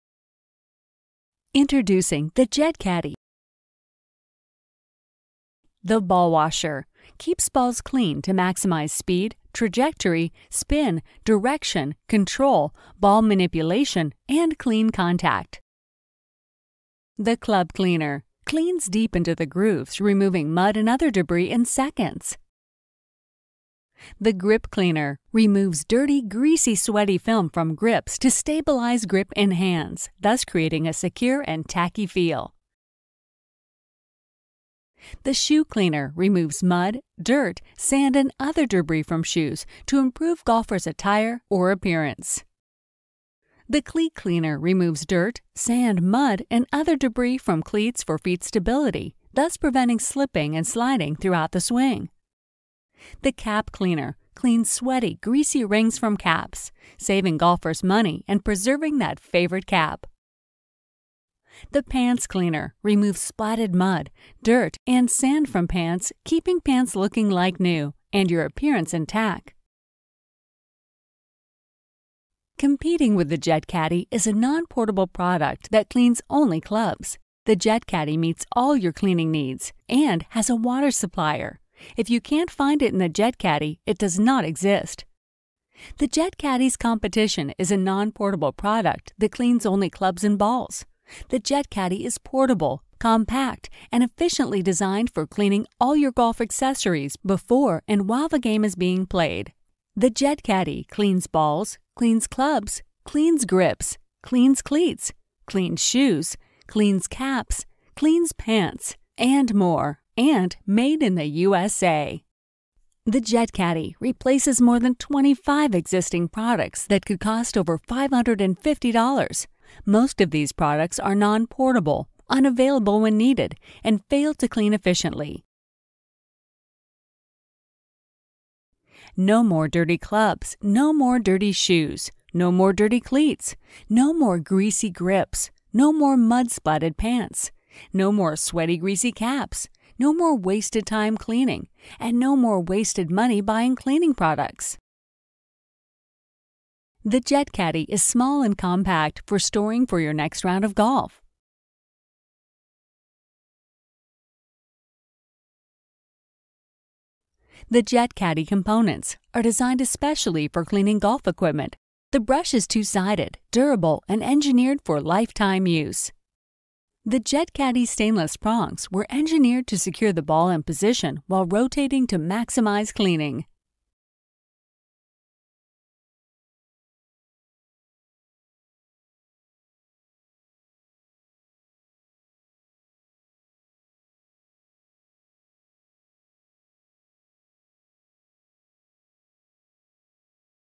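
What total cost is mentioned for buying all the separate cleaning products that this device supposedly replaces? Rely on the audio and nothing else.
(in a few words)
over $550.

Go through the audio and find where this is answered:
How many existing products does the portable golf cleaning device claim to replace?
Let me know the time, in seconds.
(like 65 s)
114 s.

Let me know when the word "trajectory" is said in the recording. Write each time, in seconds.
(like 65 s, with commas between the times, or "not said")
9 s.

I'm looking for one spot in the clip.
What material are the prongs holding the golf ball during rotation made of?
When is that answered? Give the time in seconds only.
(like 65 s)
167 s.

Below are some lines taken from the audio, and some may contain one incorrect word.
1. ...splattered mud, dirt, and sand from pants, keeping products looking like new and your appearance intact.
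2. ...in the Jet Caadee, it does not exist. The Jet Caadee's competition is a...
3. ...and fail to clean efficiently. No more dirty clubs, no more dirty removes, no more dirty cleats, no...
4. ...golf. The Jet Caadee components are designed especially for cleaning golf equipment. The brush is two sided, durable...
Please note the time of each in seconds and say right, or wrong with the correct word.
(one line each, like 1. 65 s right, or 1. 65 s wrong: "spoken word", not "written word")
1. 63 s wrong: "pants", not "products"
2. 82 s right
3. 123 s wrong: "shoes", not "removes"
4. 150 s right.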